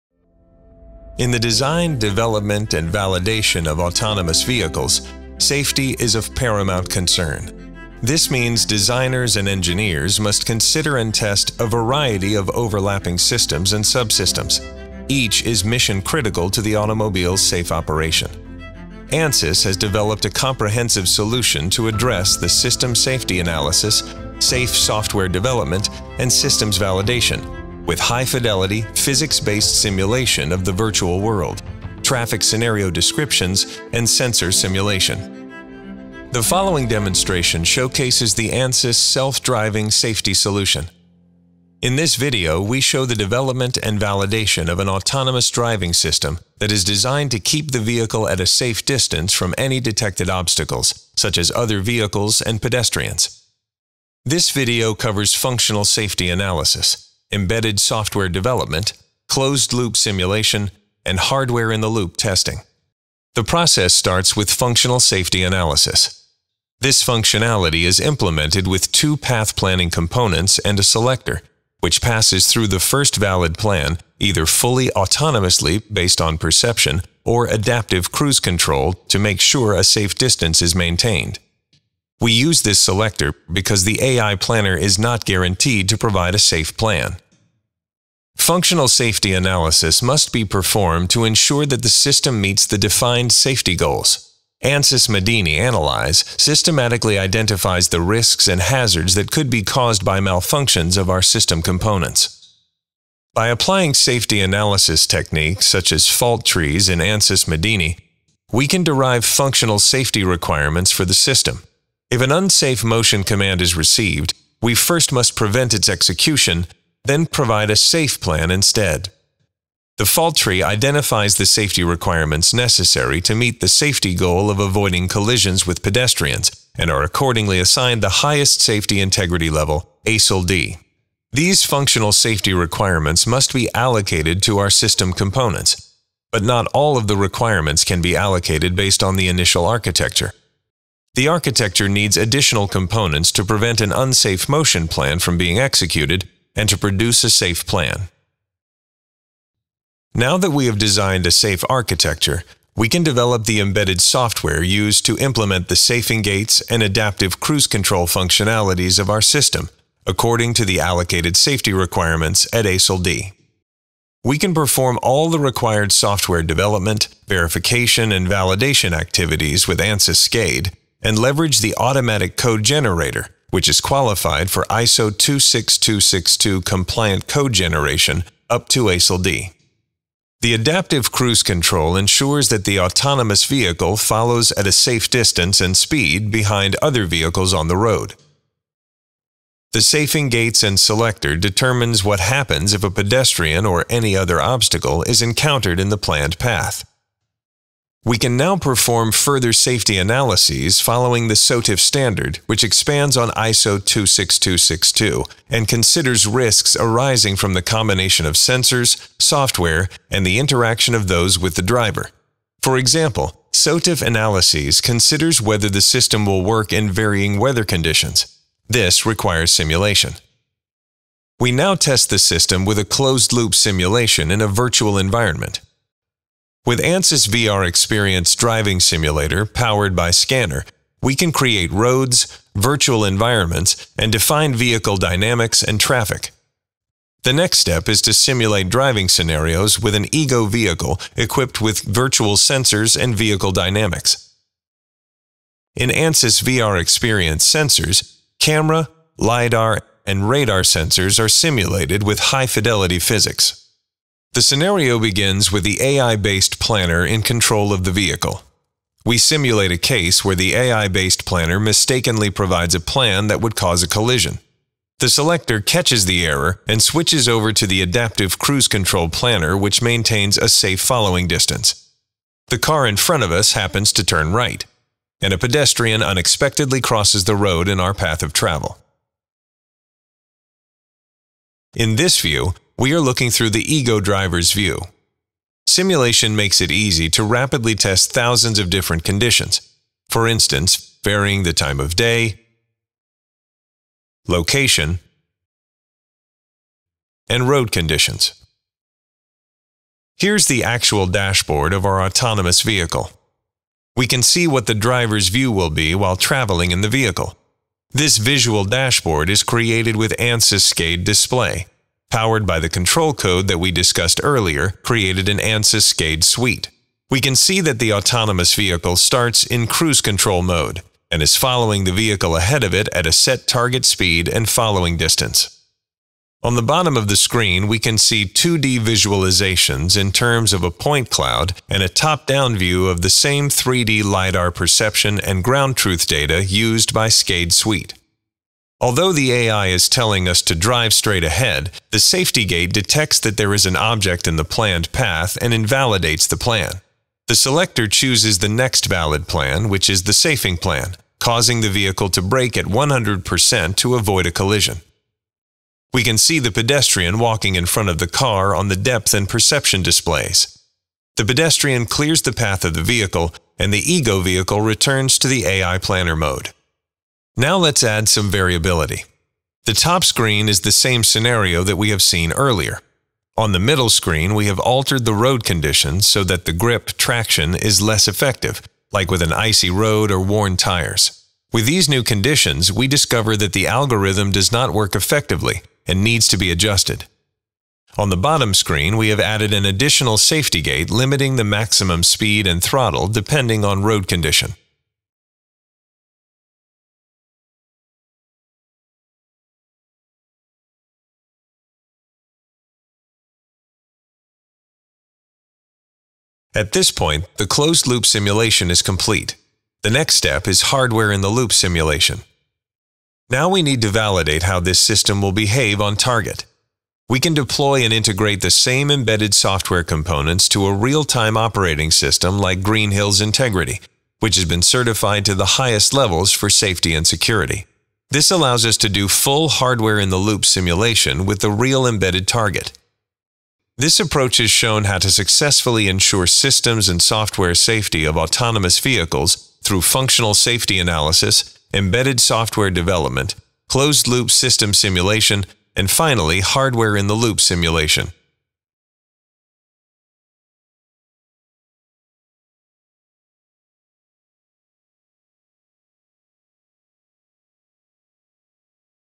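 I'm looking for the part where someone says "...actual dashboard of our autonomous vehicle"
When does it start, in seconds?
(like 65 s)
300 s.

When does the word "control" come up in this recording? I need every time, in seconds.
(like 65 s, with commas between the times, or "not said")
78 s, 157 s, 181 s, 257 s, 268 s, 312 s, 320 s.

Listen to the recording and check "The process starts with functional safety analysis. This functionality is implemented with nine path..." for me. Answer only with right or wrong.
wrong.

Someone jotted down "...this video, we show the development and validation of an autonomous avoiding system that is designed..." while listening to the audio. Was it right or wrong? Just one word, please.
wrong.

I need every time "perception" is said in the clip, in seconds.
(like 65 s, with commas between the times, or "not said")
76 s, 334 s, 359 s.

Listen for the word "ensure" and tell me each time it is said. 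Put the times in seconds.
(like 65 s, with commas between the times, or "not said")
91 s, 181 s, 435 s.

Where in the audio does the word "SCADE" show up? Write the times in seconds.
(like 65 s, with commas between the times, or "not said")
170 s, 310 s, 315 s, 337 s.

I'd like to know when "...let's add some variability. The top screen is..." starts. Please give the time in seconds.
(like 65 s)
367 s.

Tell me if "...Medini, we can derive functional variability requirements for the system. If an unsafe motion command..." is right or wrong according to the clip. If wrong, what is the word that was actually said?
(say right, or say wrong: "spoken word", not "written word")
wrong: "safety", not "variability".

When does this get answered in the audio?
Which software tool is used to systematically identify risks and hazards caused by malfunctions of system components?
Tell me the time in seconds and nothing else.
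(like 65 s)
94 s.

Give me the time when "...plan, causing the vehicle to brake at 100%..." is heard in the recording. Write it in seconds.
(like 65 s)
350 s.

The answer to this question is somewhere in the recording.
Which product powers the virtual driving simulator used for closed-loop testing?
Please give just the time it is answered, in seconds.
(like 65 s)
230 s.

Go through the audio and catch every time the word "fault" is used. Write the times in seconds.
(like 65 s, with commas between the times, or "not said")
106 s, 120 s.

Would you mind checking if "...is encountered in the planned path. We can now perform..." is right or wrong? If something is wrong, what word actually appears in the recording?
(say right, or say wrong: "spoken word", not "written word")
right.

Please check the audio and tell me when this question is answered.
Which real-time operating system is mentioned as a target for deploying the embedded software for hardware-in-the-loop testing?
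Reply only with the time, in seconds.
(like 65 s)
422 s.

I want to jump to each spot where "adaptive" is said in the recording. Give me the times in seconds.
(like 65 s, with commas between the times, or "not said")
77 s, 156 s, 180 s, 267 s.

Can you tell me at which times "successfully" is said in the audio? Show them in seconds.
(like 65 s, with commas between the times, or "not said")
435 s.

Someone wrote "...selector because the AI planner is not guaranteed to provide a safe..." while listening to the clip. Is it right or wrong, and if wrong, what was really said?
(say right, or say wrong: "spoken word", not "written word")
right.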